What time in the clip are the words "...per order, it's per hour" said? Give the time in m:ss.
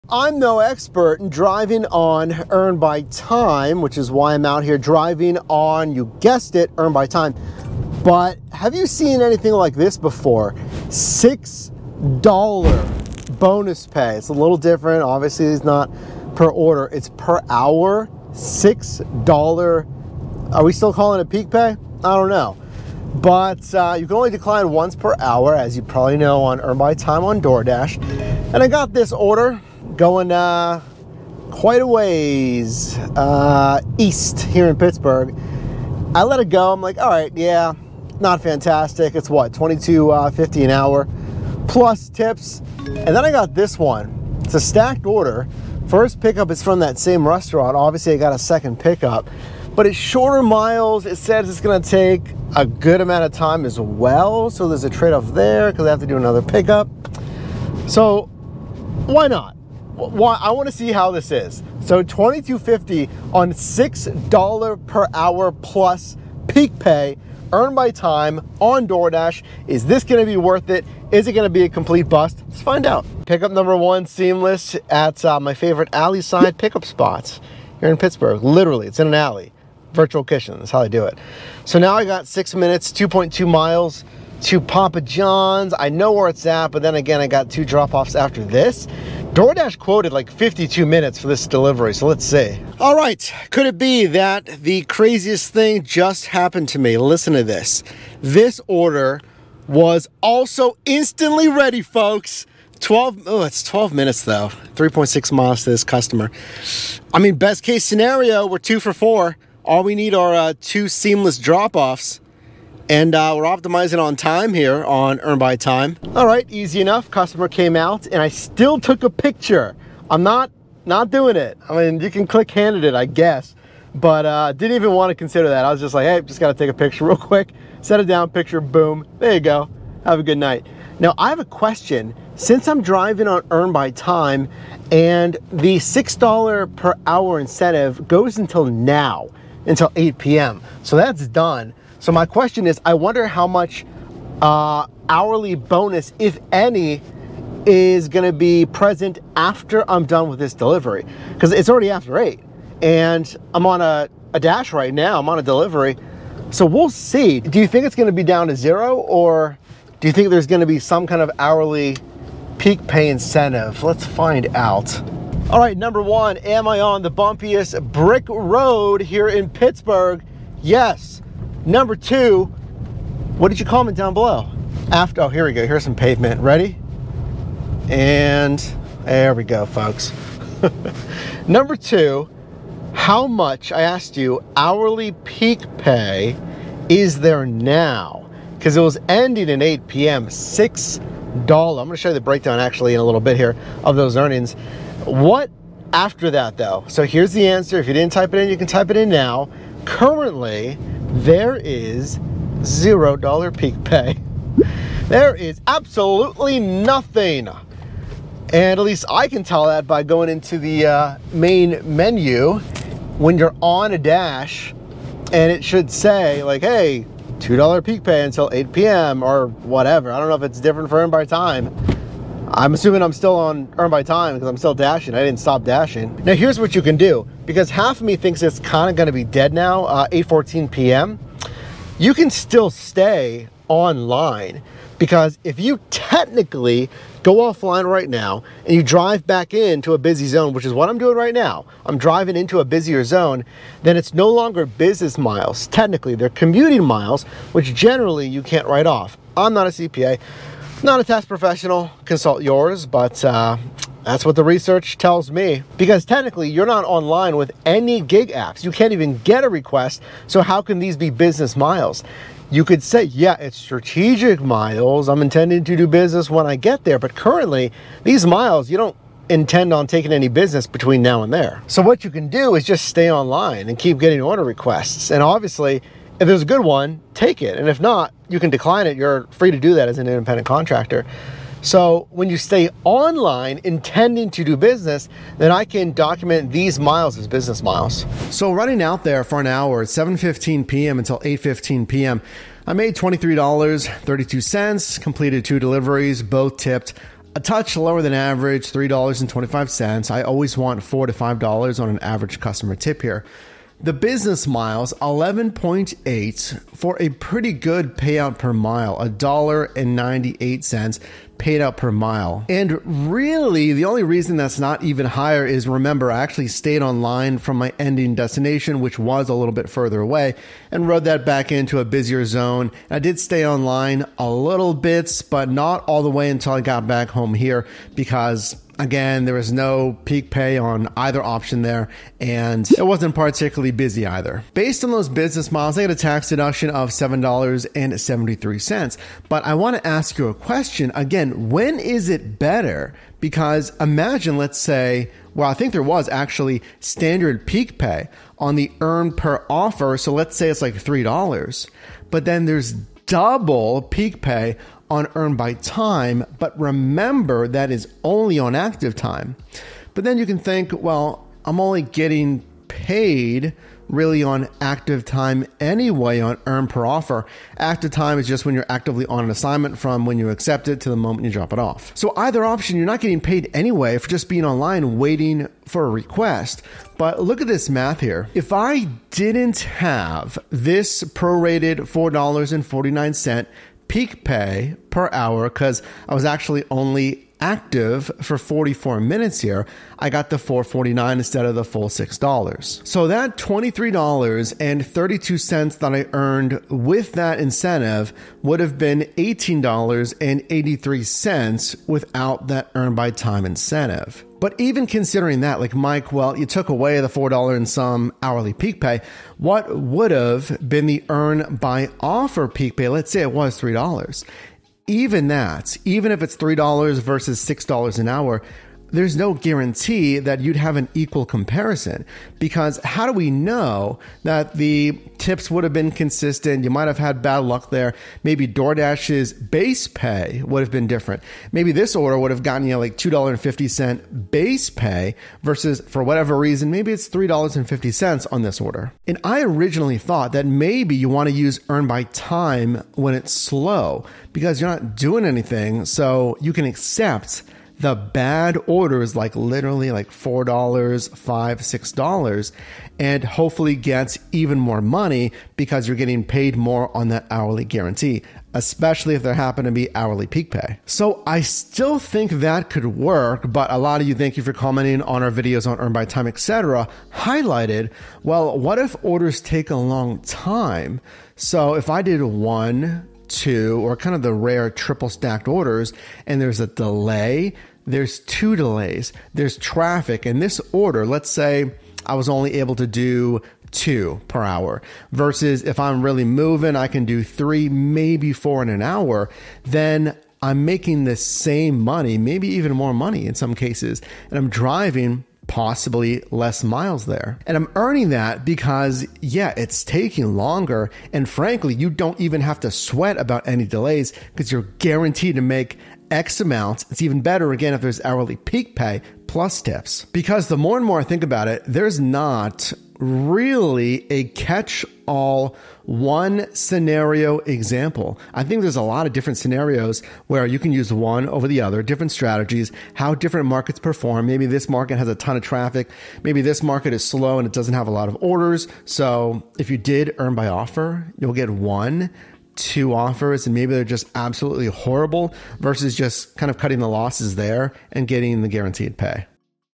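0:16.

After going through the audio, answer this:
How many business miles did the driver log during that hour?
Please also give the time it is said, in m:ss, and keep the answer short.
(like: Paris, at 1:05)
11.8, at 5:05.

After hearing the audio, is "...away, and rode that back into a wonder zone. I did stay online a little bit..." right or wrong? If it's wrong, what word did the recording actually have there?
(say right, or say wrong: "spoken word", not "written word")
wrong: "busier", not "wonder".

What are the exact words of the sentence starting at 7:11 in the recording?
Maybe this order would have gotten you like $2.50 base pay versus for whatever reason, maybe it's $3.50 on this order.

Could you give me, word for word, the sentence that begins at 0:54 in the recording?
So there's a trade off there because I have to do another pickup.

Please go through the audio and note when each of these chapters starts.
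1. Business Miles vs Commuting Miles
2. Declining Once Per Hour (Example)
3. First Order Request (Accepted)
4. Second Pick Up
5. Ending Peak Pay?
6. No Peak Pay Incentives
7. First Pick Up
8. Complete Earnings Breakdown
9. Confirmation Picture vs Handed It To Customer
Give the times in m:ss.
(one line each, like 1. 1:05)
1. 3:51
2. 0:27
3. 0:42
4. 1:32
5. 2:10
6. 3:24
7. 1:13
8. 4:47
9. 1:55.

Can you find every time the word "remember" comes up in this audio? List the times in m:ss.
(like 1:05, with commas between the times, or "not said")
5:15, 5:56.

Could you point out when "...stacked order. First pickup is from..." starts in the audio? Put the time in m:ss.
0:44.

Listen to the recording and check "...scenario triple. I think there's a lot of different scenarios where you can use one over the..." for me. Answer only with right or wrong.
wrong.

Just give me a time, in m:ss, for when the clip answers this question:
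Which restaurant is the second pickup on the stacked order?
1:24.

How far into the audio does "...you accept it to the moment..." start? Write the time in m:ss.
6:10.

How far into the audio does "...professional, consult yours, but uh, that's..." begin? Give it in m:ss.
4:11.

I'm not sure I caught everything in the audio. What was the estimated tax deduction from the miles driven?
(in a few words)
$7.73.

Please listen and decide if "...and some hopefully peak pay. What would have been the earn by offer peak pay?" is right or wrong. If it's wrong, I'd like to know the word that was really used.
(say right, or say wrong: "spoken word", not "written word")
wrong: "hourly", not "hopefully".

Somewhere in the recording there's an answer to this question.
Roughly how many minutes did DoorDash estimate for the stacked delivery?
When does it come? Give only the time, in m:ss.
1:30.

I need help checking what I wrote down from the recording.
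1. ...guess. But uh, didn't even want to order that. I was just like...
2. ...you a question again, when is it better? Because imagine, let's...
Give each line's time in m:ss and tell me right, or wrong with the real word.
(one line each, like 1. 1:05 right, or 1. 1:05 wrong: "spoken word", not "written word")
1. 2:03 wrong: "consider", not "order"
2. 5:40 right.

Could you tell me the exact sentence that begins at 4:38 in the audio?
You're free to do that as an independent contractor.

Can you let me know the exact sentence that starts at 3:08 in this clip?
Because it was ending at 8 p.m., $6.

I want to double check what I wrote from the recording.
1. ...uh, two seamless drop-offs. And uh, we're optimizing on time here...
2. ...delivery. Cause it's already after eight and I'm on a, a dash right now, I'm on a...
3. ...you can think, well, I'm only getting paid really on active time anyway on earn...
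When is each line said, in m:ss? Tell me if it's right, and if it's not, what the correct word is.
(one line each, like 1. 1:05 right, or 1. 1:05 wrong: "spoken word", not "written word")
1. 1:50 right
2. 2:30 right
3. 6:00 right.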